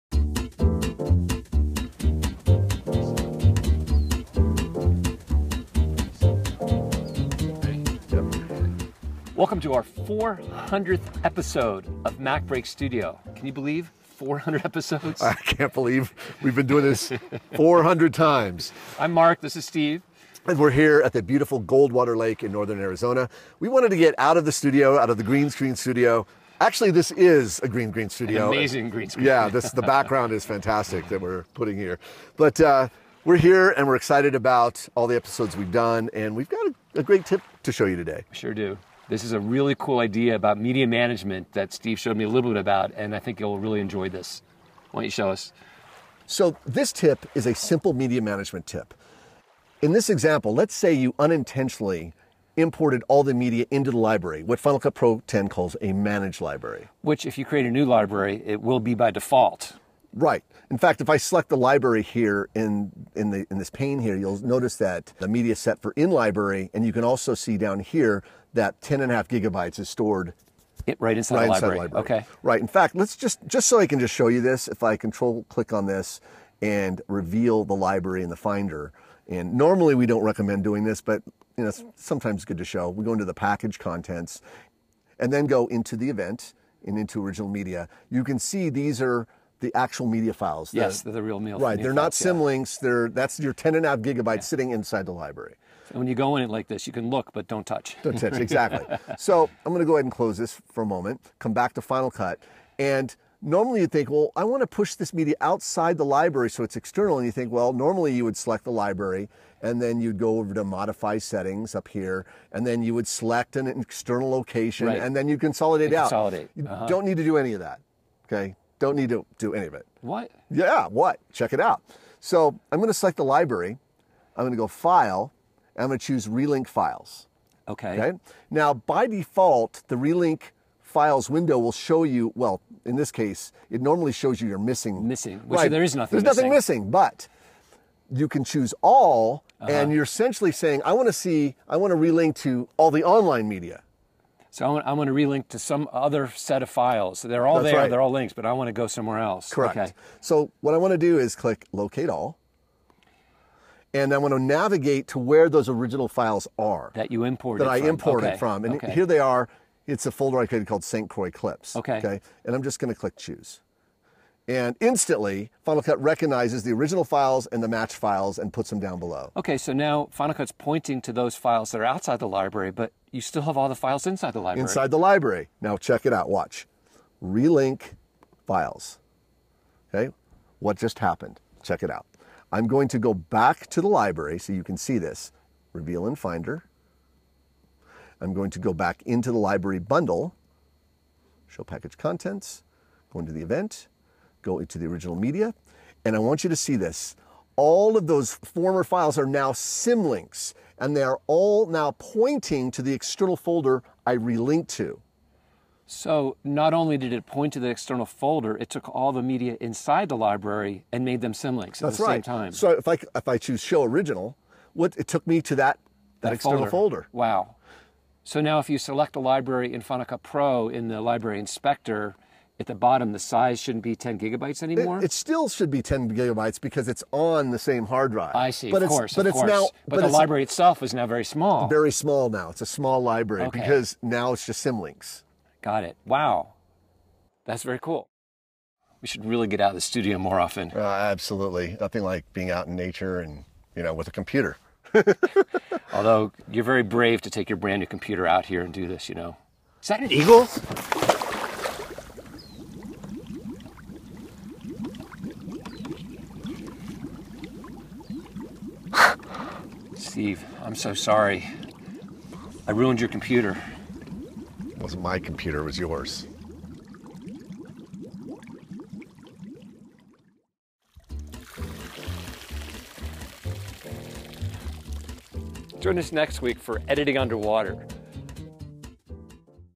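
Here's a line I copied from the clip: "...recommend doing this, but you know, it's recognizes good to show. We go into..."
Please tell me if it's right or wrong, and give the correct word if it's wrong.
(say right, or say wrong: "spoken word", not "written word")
wrong: "sometimes", not "recognizes".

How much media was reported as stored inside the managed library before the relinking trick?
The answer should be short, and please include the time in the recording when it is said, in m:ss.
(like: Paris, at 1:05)
10.5 gigabytes, at 1:08.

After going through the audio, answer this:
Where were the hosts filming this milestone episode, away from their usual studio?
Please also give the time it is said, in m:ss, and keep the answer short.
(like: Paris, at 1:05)
Goldwater Lake, at 0:21.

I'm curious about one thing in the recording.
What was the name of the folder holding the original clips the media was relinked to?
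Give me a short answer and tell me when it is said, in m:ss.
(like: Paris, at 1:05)
St. Croix Clips, at 2:40.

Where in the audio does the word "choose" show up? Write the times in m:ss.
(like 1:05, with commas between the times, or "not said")
2:06, 2:18, 2:43, 3:33.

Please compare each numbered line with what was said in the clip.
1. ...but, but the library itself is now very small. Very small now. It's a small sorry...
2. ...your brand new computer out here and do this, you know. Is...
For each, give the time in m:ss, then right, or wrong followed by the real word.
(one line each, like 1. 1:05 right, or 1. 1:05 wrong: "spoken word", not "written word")
1. 3:49 wrong: "library", not "sorry"
2. 4:07 right.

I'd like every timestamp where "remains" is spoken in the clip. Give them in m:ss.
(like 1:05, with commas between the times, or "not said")
not said.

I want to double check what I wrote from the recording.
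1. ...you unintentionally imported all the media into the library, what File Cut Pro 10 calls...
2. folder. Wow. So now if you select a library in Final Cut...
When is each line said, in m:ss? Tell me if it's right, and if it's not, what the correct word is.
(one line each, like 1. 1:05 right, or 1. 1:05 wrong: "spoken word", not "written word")
1. 0:50 wrong: "Final", not "File"
2. 3:37 right.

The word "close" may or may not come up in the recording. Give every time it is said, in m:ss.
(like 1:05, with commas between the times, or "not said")
1:40.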